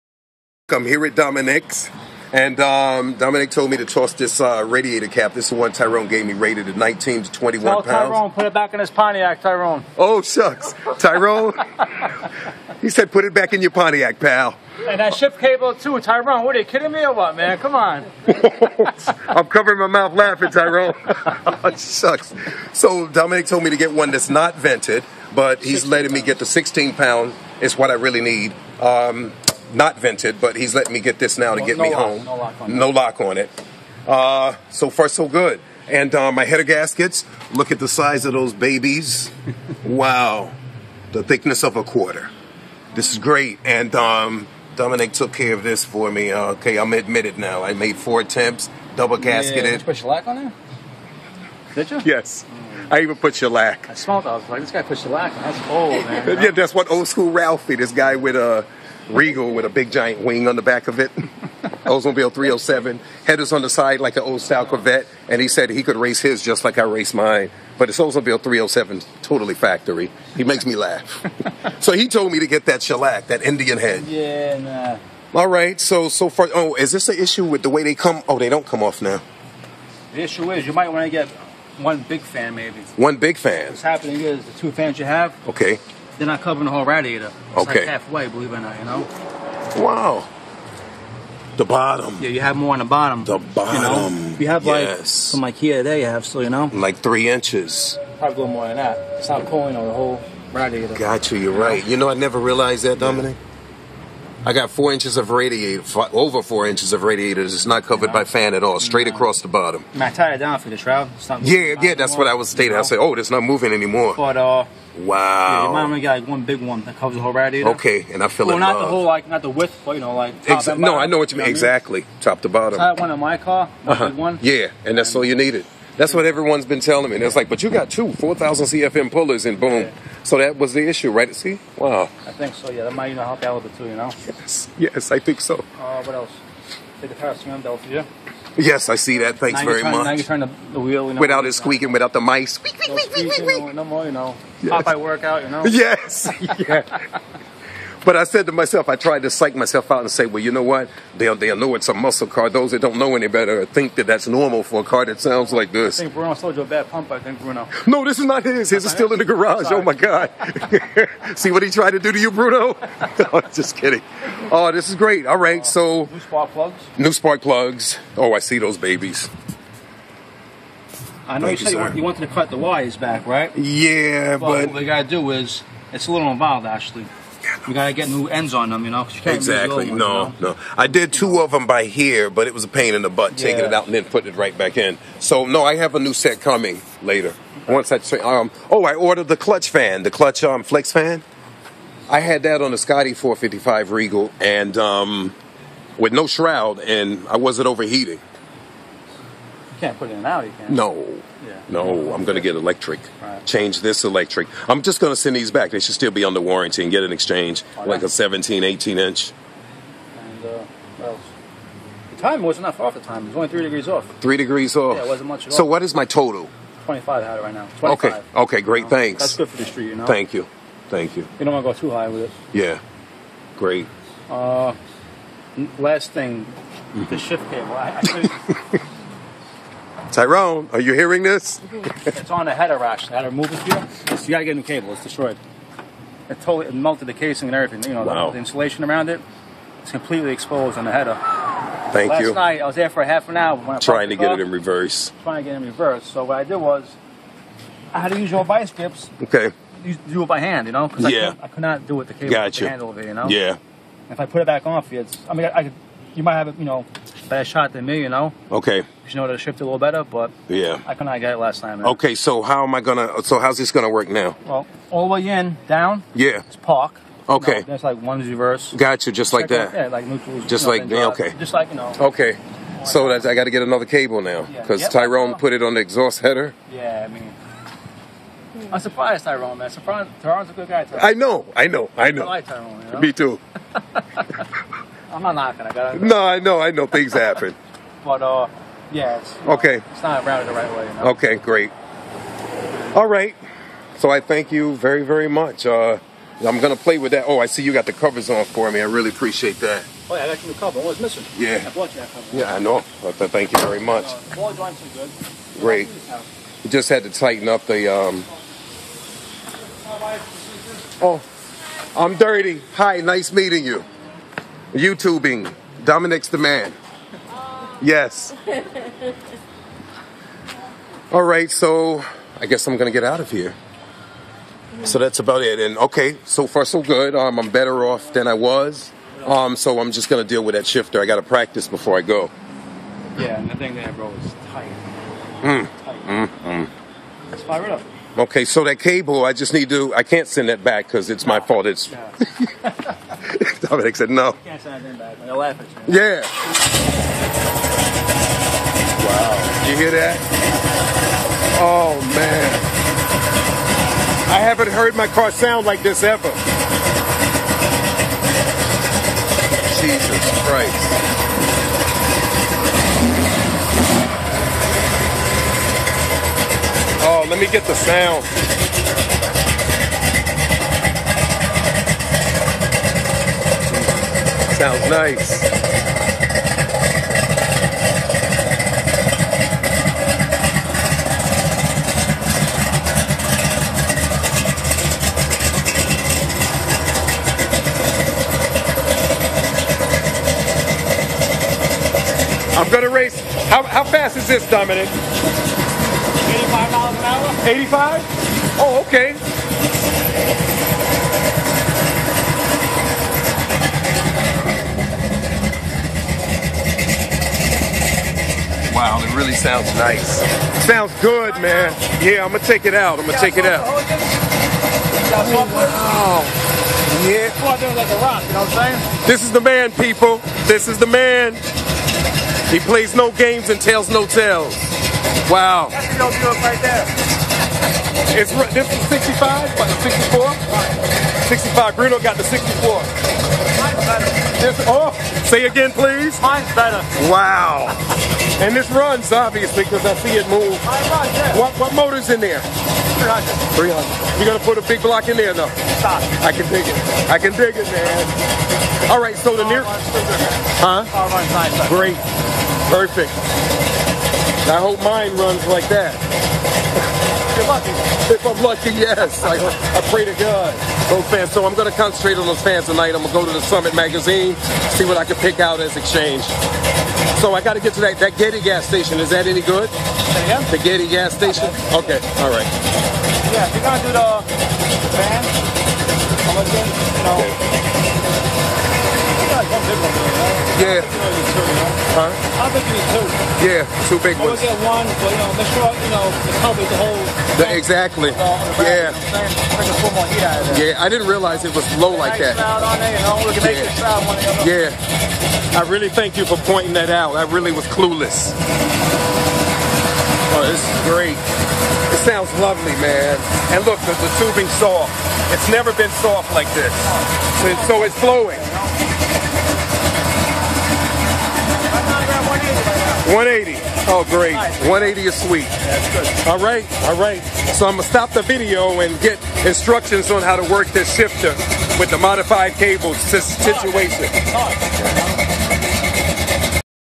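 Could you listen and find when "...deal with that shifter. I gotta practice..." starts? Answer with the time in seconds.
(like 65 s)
330 s.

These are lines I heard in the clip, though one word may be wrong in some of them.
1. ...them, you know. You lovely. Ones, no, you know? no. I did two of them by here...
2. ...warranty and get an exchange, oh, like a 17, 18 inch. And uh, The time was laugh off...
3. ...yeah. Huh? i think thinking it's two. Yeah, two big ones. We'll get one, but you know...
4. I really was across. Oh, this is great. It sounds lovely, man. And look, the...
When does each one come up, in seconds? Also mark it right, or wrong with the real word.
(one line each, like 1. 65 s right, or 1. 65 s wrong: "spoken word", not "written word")
1. 178 s wrong: "exactly", not "lovely"
2. 206 s wrong: "enough", not "laugh"
3. 480 s right
4. 497 s wrong: "clueless", not "across".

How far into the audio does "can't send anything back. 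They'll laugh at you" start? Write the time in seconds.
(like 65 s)
344 s.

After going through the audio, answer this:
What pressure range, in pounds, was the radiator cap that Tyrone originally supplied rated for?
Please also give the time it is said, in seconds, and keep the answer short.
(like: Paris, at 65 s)
19 to 21, at 6 s.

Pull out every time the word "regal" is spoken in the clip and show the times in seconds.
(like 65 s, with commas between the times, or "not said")
59 s, 193 s.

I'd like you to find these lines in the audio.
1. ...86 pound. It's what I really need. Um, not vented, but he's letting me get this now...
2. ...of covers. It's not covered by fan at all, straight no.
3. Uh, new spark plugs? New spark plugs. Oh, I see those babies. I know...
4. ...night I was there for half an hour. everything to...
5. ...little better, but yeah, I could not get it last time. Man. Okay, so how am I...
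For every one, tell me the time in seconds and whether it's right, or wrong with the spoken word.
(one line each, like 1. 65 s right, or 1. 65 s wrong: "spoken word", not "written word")
1. 26 s wrong: "16", not "86"
2. 106 s wrong: "radiators", not "covers"
3. 166 s right
4. 242 s wrong: "trying", not "everything"
5. 259 s right.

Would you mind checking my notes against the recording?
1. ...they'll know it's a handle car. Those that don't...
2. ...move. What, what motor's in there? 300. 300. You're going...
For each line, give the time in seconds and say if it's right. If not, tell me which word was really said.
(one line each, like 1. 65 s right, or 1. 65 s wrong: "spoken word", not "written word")
1. 151 s wrong: "muscle", not "handle"
2. 440 s right.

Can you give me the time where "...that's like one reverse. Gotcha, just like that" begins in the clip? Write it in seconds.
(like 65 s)
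267 s.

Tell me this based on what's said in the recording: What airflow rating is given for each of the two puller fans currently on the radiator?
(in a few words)
4,000 CFM.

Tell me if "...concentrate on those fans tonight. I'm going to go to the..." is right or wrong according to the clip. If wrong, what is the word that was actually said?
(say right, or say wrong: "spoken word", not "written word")
right.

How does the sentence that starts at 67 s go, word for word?
But it's Oldsmobile 307, totally factory.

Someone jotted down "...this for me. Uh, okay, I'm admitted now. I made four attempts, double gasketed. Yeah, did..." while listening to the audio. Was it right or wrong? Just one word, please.
right.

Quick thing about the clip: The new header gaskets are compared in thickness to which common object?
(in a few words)
a quarter.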